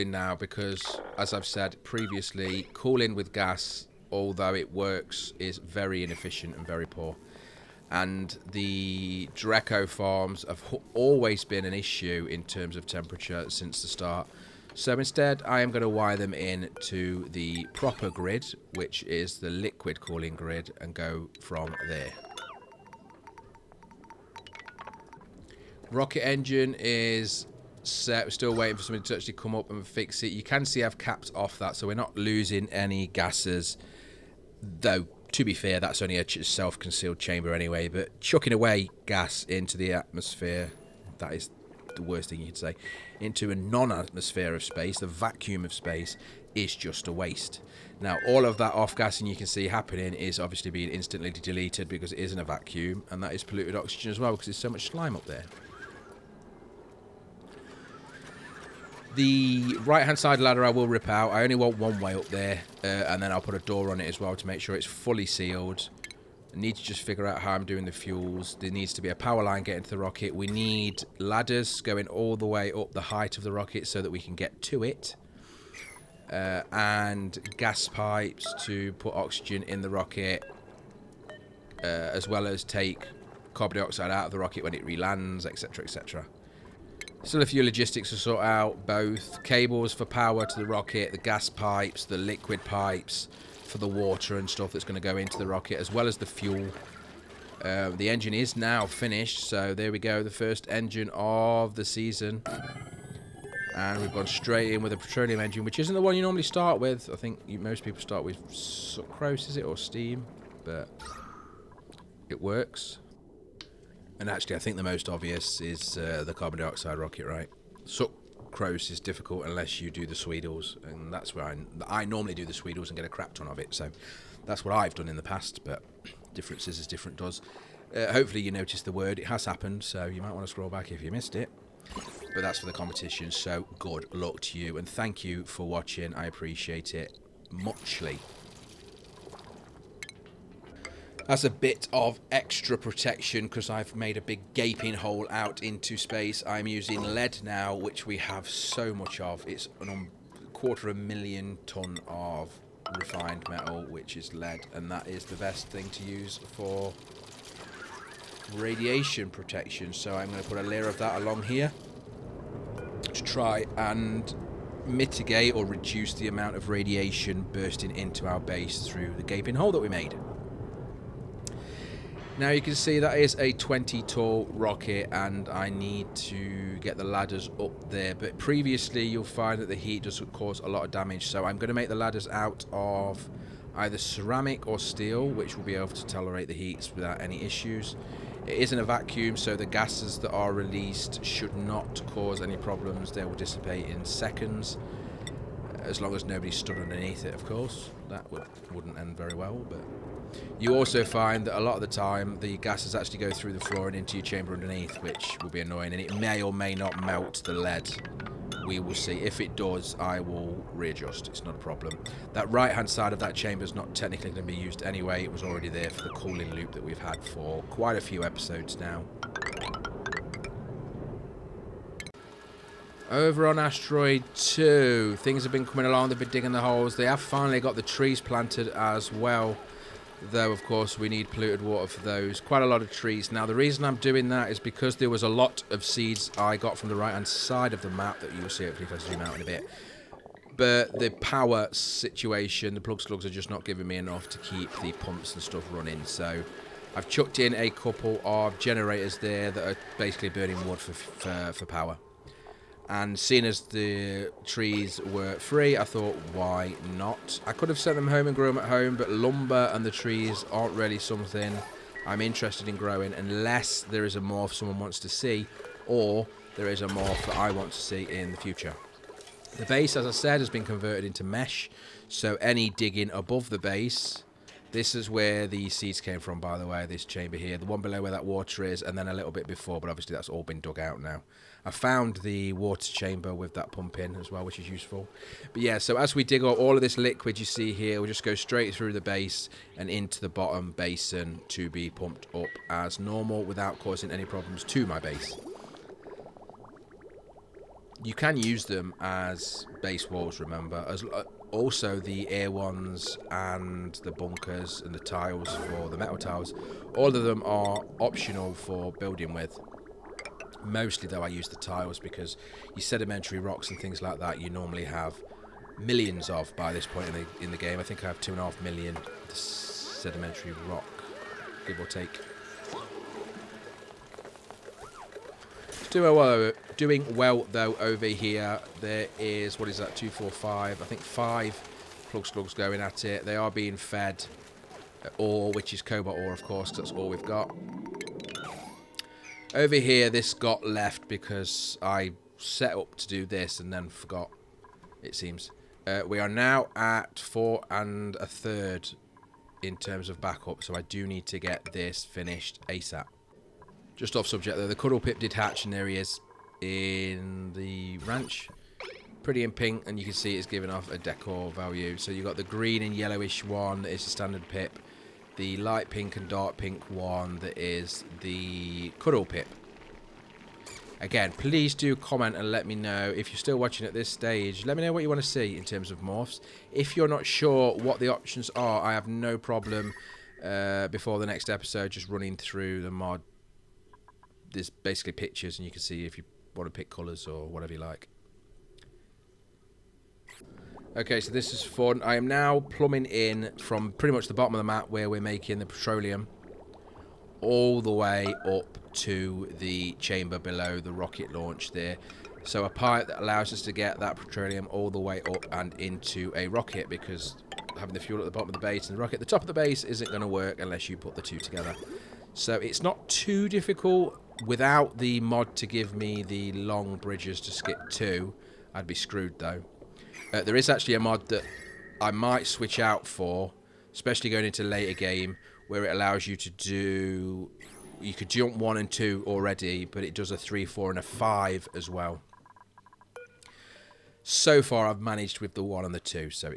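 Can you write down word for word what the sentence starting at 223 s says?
Over on Asteroid 2, things have been coming along.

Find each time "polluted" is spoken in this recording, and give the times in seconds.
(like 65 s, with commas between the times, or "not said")
53 s, 231 s.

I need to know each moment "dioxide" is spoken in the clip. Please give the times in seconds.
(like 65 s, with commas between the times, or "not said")
83 s, 116 s.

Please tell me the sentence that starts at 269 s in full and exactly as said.
The base, as I said, has been converted into mesh, so any digging above the base...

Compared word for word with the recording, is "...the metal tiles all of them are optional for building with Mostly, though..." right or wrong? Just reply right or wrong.
right.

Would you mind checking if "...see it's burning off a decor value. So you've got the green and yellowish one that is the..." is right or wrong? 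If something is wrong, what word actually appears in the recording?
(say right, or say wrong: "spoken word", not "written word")
wrong: "giving", not "burning".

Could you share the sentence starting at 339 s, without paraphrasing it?
Over here, this got left because I set up to do this and then forgot, it seems.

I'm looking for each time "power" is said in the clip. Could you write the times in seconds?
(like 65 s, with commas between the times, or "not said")
69 s, 90 s, 241 s, 251 s.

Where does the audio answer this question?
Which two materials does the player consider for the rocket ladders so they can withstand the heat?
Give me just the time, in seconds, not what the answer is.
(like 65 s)
183 s.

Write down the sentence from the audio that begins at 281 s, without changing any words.
I found the water chamber with that pump in as well, which is useful.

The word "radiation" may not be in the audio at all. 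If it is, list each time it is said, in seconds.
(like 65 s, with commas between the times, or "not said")
158 s, 166 s.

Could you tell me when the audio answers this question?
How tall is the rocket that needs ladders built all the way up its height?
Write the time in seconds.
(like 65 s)
173 s.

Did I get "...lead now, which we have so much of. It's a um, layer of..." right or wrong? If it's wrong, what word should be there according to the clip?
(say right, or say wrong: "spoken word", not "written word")
wrong: "quarter", not "layer".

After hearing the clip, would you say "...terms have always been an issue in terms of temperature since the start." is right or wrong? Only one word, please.
wrong.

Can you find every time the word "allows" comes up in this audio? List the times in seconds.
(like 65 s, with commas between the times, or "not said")
403 s, 425 s.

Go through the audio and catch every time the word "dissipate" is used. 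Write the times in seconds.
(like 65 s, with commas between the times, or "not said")
193 s.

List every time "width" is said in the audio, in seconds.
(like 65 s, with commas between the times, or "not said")
not said.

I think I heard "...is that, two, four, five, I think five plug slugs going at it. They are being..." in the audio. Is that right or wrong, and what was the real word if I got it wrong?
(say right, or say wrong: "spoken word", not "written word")
right.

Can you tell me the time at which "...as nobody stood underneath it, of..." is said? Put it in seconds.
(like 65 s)
196 s.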